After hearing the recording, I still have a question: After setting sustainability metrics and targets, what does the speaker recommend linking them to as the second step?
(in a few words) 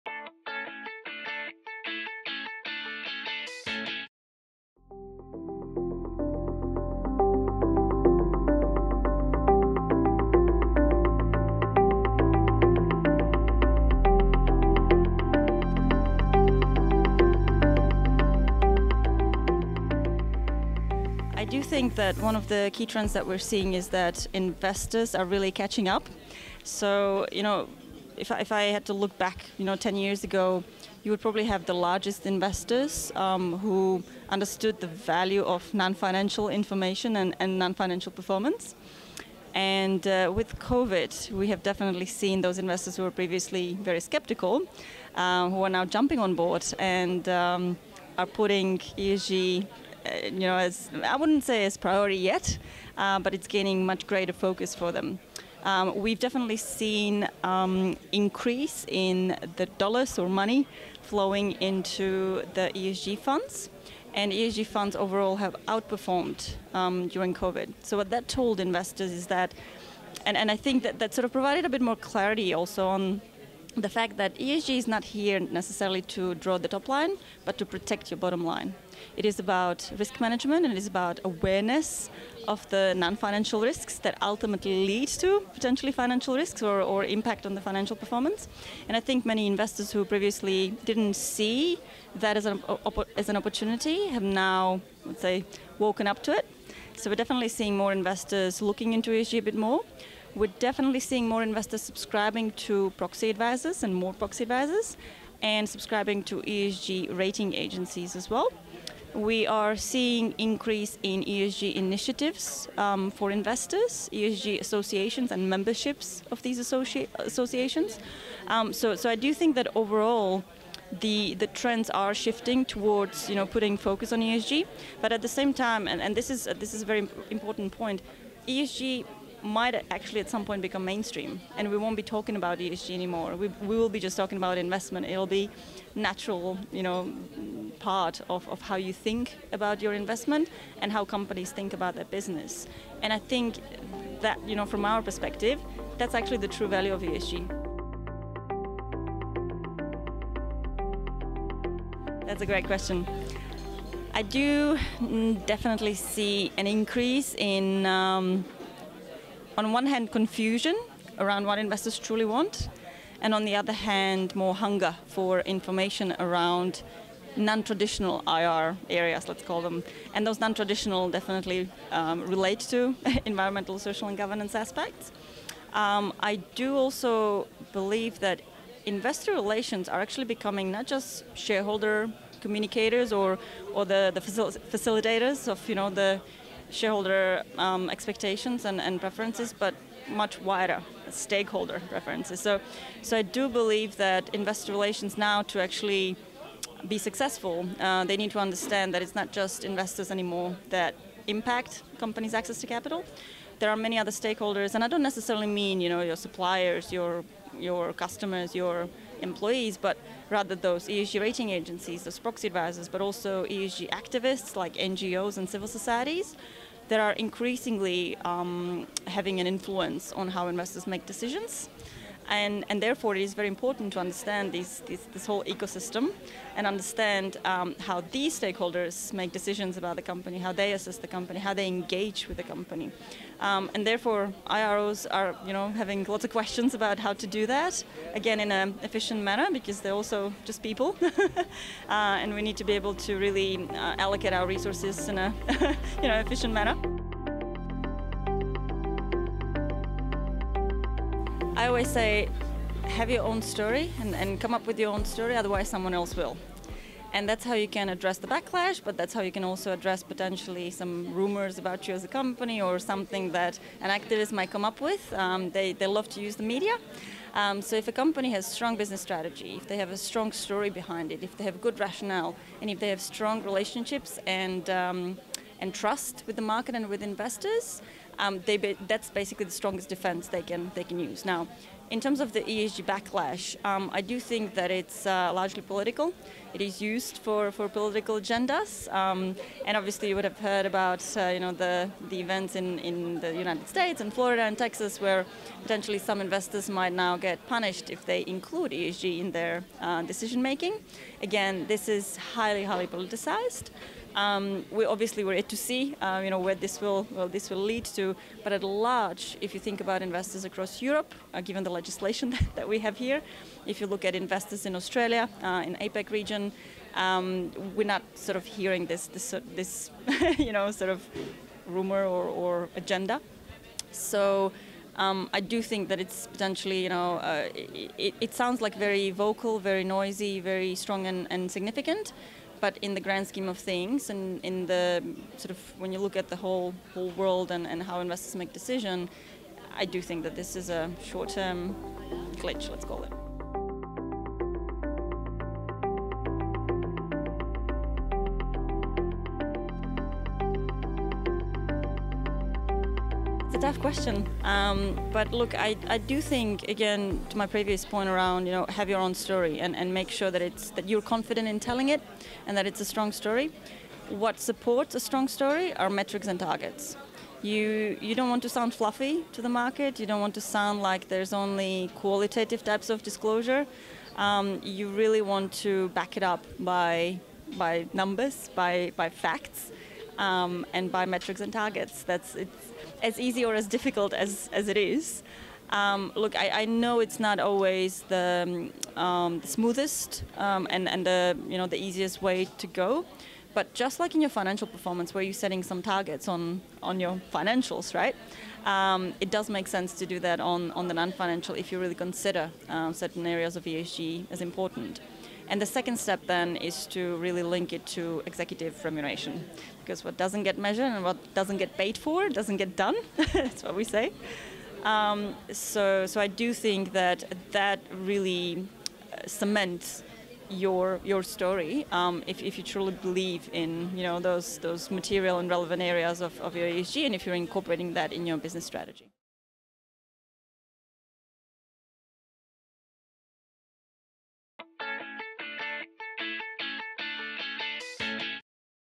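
Executive remuneration.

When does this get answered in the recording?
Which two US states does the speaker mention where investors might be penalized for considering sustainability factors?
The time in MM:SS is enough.
04:54.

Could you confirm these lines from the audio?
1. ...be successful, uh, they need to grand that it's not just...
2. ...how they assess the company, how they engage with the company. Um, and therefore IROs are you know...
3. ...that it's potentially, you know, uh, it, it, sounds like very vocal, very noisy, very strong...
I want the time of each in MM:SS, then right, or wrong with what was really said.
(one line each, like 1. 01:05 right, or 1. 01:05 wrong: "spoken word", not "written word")
1. 03:16 wrong: "understand", not "grand"
2. 03:50 right
3. 05:25 right.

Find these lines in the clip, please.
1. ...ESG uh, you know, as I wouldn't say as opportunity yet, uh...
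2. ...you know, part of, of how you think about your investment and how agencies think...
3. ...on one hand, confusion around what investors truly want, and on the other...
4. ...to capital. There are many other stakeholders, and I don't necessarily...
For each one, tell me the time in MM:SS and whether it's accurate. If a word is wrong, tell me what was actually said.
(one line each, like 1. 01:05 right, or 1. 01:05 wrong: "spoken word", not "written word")
1. 00:48 wrong: "priority", not "opportunity"
2. 02:16 wrong: "companies", not "agencies"
3. 02:39 right
4. 03:22 right.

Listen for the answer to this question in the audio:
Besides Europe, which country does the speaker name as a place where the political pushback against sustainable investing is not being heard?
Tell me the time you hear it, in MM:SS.
05:14.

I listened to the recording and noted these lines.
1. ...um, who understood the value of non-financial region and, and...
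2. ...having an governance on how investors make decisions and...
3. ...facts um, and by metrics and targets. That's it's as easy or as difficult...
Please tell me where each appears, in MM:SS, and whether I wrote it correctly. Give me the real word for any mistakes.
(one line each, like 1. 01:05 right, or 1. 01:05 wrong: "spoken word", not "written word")
1. 00:33 wrong: "information", not "region"
2. 03:39 wrong: "influence", not "governance"
3. 06:19 right.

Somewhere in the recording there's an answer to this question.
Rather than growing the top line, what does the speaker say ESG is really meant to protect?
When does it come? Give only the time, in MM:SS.
01:18.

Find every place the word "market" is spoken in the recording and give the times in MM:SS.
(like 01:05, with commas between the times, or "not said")
04:36, 06:09.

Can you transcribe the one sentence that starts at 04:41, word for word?
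Now, in terms of the ESG backlash, um, I do think that it's uh, largely political.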